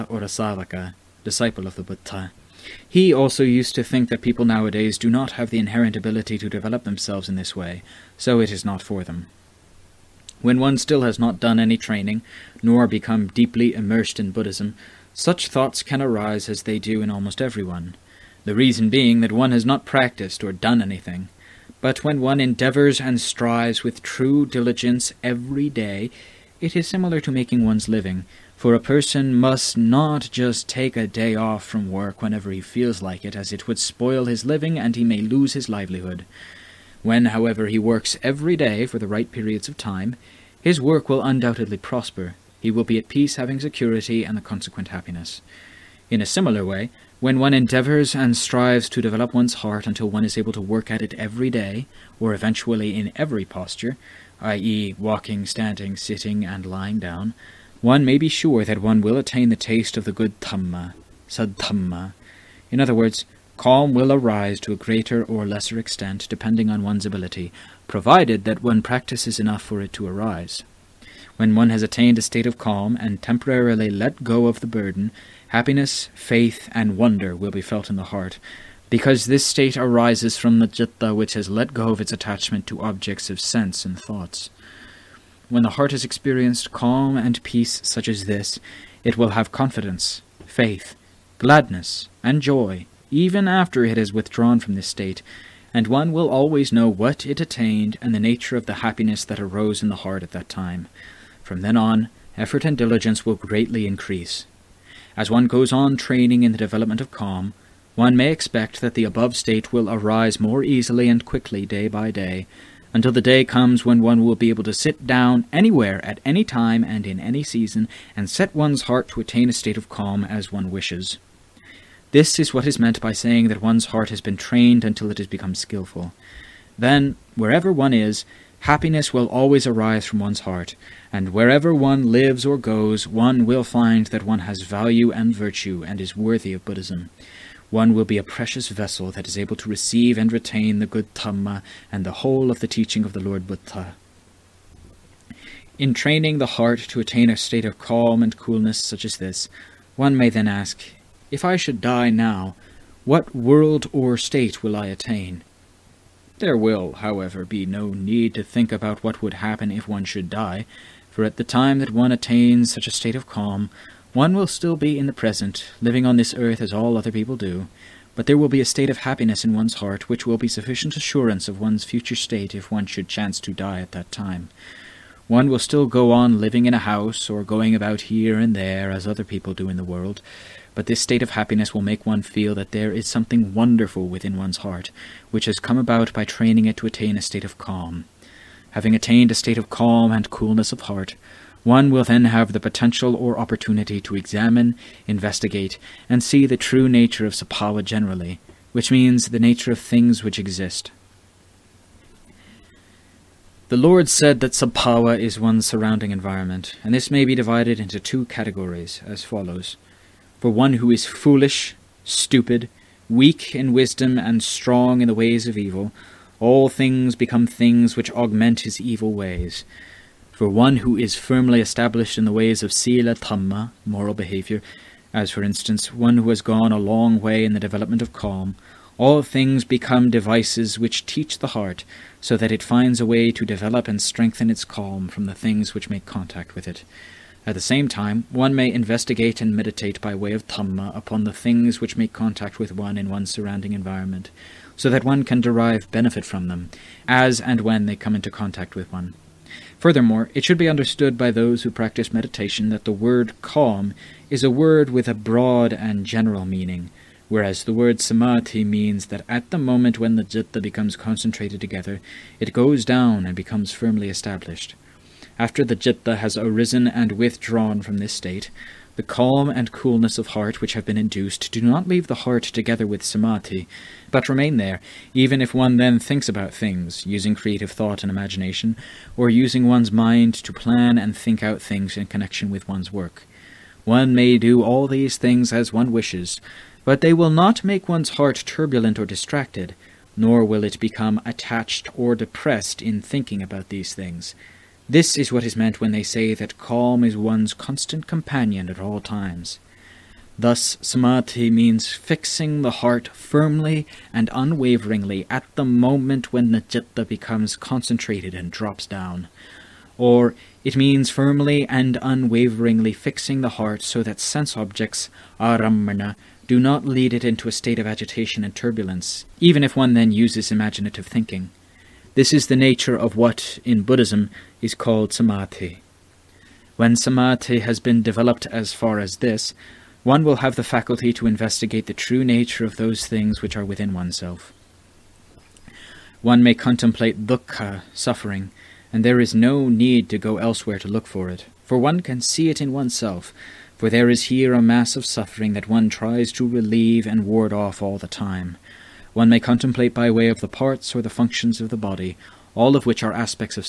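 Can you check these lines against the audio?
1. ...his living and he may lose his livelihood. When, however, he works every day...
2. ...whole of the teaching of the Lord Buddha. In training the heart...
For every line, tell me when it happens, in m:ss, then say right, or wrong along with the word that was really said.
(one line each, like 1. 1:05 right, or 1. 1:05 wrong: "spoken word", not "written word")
1. 0:34 right
2. 2:22 right.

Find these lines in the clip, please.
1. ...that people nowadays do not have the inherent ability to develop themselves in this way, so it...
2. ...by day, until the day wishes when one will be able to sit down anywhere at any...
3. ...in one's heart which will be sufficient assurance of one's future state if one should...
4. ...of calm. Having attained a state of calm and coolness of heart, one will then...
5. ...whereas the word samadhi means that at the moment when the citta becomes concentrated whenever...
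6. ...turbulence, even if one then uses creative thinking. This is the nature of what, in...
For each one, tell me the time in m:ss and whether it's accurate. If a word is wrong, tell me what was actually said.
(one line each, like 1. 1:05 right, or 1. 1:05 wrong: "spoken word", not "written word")
1. 0:04 right
2. 1:51 wrong: "comes", not "wishes"
3. 2:49 right
4. 3:07 right
5. 4:17 wrong: "together", not "whenever"
6. 5:18 wrong: "imaginative", not "creative".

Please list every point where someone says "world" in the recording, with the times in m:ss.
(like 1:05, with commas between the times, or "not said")
2:33, 2:59.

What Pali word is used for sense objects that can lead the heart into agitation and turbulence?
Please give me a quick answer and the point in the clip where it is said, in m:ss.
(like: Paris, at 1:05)
aramana, at 5:15.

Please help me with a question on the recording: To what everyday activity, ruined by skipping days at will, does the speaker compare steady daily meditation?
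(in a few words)
Making one's living.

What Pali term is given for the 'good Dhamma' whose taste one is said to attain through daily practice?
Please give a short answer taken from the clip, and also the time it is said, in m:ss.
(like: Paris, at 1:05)
Sadhamma, at 1:01.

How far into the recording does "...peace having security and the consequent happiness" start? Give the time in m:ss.
0:43.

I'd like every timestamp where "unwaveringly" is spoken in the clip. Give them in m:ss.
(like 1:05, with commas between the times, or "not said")
5:04, 5:12.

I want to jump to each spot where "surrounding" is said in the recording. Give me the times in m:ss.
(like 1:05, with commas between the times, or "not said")
3:25, 4:03.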